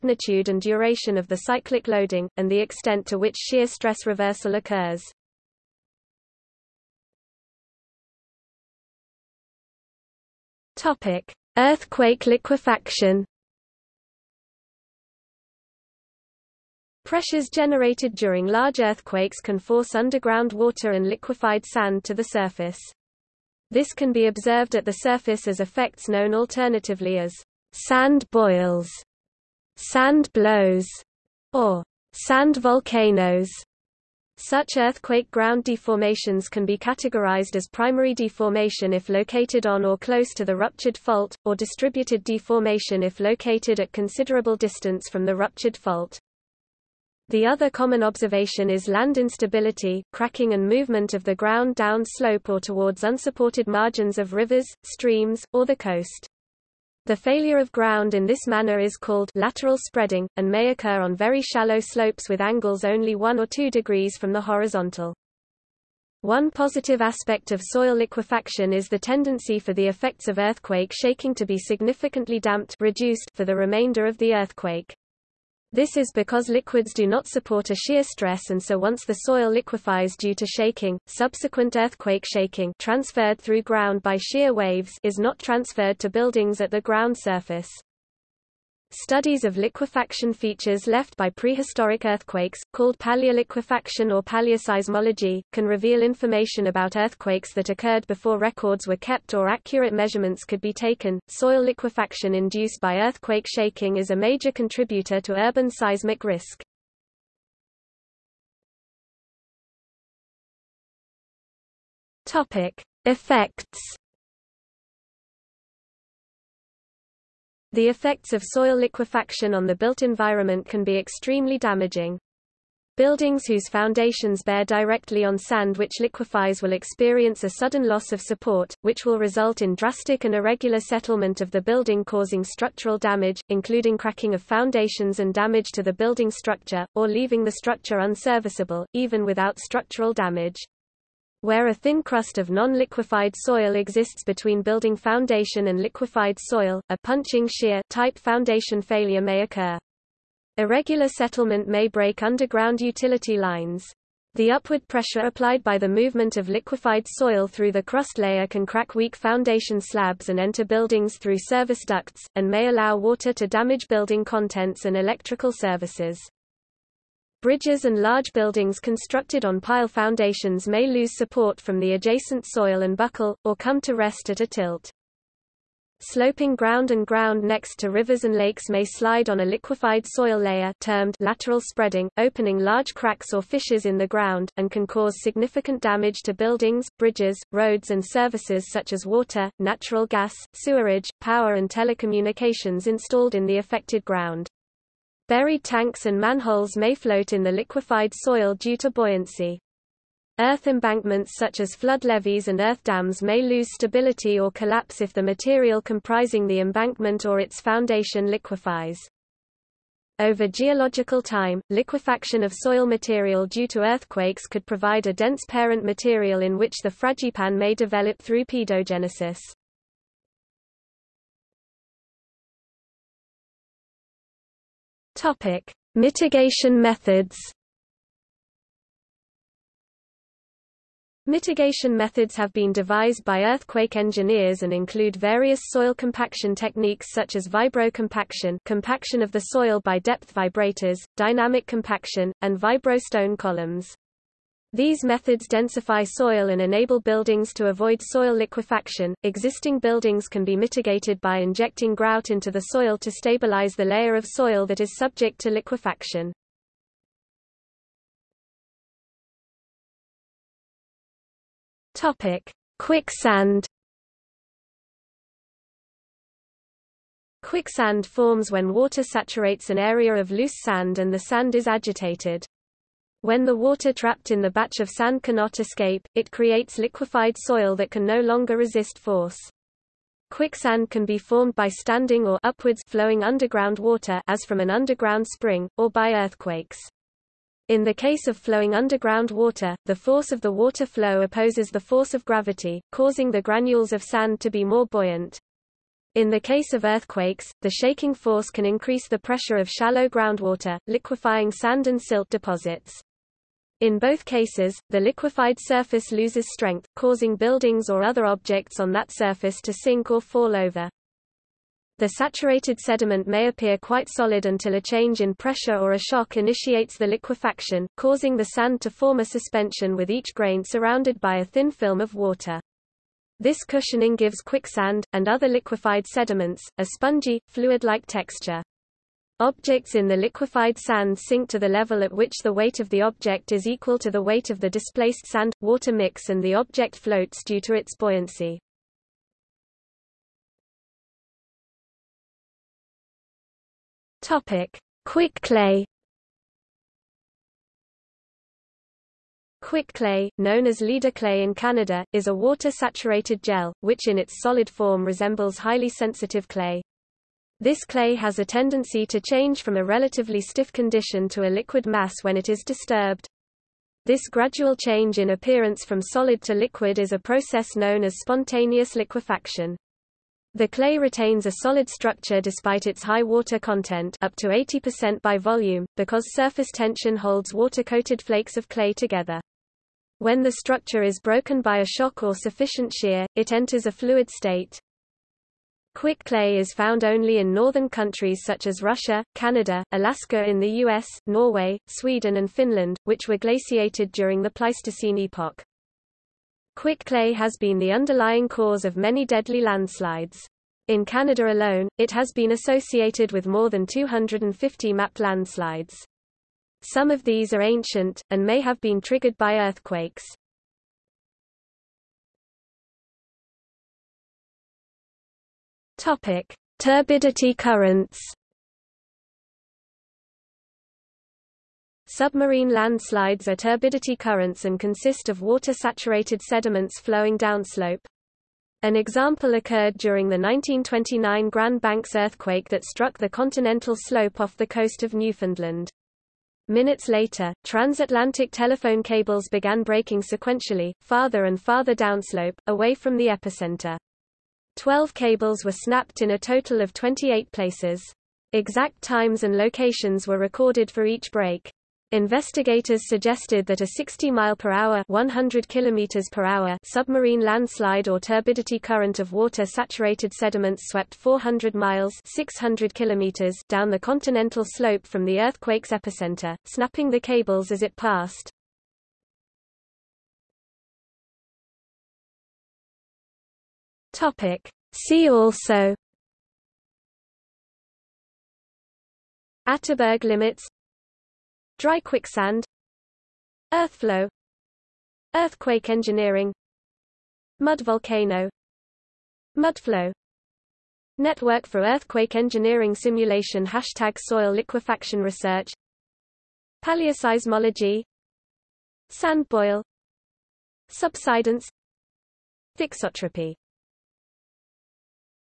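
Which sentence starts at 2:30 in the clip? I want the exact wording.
Irregular settlement may break underground utility lines.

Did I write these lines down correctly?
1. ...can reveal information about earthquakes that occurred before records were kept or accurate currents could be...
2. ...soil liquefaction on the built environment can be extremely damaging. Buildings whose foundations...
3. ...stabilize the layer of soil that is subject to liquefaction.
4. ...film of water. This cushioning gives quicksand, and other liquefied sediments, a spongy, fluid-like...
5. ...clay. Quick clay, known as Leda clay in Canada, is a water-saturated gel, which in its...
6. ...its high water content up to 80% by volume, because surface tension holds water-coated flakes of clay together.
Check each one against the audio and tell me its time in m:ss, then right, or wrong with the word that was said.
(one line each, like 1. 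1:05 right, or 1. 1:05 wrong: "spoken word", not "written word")
1. 1:35 wrong: "measurements", not "currents"
2. 1:58 right
3. 4:13 right
4. 5:21 right
5. 5:45 right
6. 6:12 right.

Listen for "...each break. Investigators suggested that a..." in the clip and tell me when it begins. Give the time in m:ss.
7:31.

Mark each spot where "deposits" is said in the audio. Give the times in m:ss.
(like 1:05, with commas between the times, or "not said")
5:02.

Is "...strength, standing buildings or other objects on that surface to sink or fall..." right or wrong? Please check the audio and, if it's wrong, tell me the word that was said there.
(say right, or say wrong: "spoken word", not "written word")
wrong: "causing", not "standing".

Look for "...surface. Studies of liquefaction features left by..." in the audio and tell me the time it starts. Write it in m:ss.
1:27.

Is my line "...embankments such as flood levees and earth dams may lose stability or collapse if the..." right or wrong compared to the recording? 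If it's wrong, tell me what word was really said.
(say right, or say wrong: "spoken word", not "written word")
right.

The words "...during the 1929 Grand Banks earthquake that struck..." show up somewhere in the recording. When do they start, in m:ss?
7:09.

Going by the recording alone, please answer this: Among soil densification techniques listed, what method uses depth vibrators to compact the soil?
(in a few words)
vibrocompaction.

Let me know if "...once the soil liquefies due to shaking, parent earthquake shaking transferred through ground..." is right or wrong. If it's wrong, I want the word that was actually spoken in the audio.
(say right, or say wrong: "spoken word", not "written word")
wrong: "subsequent", not "parent".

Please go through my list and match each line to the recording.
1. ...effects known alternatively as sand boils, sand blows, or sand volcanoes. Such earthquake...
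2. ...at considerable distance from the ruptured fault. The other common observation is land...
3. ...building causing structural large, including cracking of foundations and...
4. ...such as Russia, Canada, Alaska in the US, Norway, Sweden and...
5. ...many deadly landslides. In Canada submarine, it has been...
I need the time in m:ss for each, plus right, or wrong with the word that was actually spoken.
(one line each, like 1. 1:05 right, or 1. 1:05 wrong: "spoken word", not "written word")
1. 0:25 right
2. 0:43 right
3. 2:11 wrong: "damage", not "large"
4. 6:28 right
5. 6:38 wrong: "alone", not "submarine".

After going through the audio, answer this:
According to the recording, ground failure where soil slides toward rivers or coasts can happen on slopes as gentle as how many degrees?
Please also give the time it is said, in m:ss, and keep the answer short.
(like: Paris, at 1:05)
1 or 2 degrees, at 1:03.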